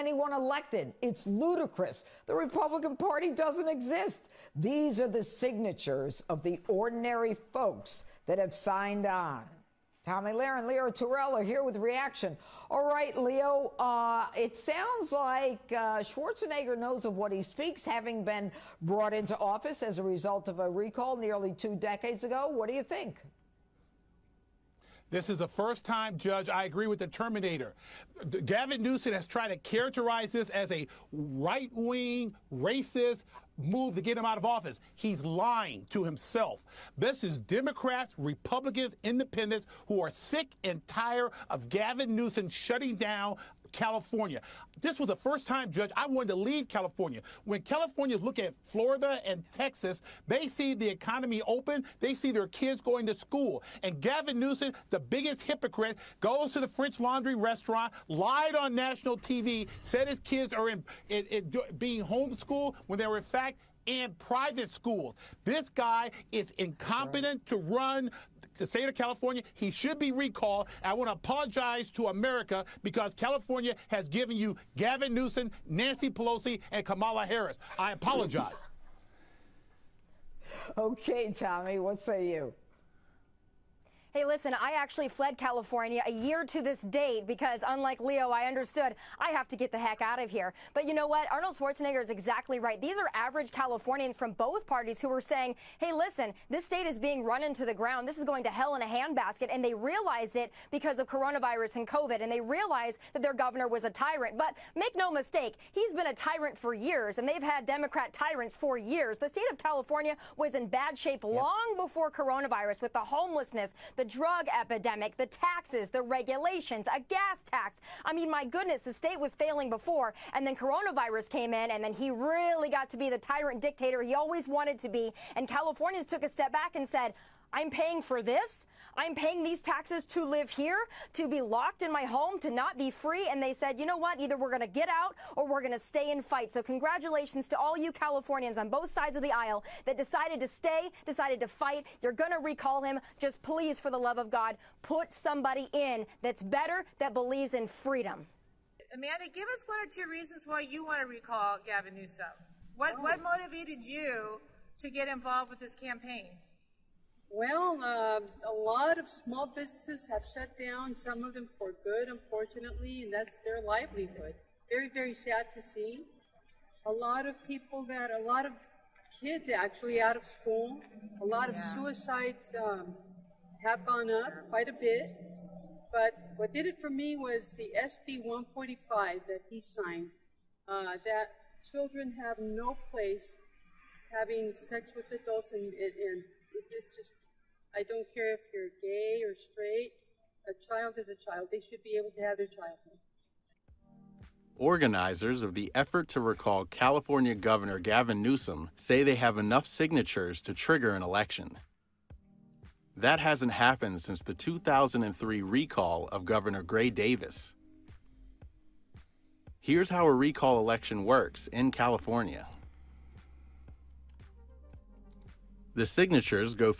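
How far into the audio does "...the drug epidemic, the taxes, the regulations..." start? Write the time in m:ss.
1:53.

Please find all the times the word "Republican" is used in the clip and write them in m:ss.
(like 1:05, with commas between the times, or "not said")
0:02, 0:38.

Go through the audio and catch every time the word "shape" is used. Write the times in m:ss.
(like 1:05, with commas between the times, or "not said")
1:50.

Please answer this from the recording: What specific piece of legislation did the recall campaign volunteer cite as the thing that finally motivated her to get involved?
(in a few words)
SB 145.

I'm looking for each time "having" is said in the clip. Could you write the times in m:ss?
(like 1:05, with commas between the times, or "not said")
0:17, 3:04.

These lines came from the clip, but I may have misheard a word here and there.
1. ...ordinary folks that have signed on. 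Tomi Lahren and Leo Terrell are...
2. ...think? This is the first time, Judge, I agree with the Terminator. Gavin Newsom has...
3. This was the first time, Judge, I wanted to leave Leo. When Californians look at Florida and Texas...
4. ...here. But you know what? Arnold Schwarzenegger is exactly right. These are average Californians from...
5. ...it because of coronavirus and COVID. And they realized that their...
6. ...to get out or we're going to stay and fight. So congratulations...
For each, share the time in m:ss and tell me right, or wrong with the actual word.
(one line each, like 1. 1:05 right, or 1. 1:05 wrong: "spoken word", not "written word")
1. 0:06 right
2. 0:22 right
3. 0:44 wrong: "California", not "Leo"
4. 1:30 right
5. 1:40 right
6. 2:14 right.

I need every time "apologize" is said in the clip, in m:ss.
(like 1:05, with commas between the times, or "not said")
1:11, 1:17.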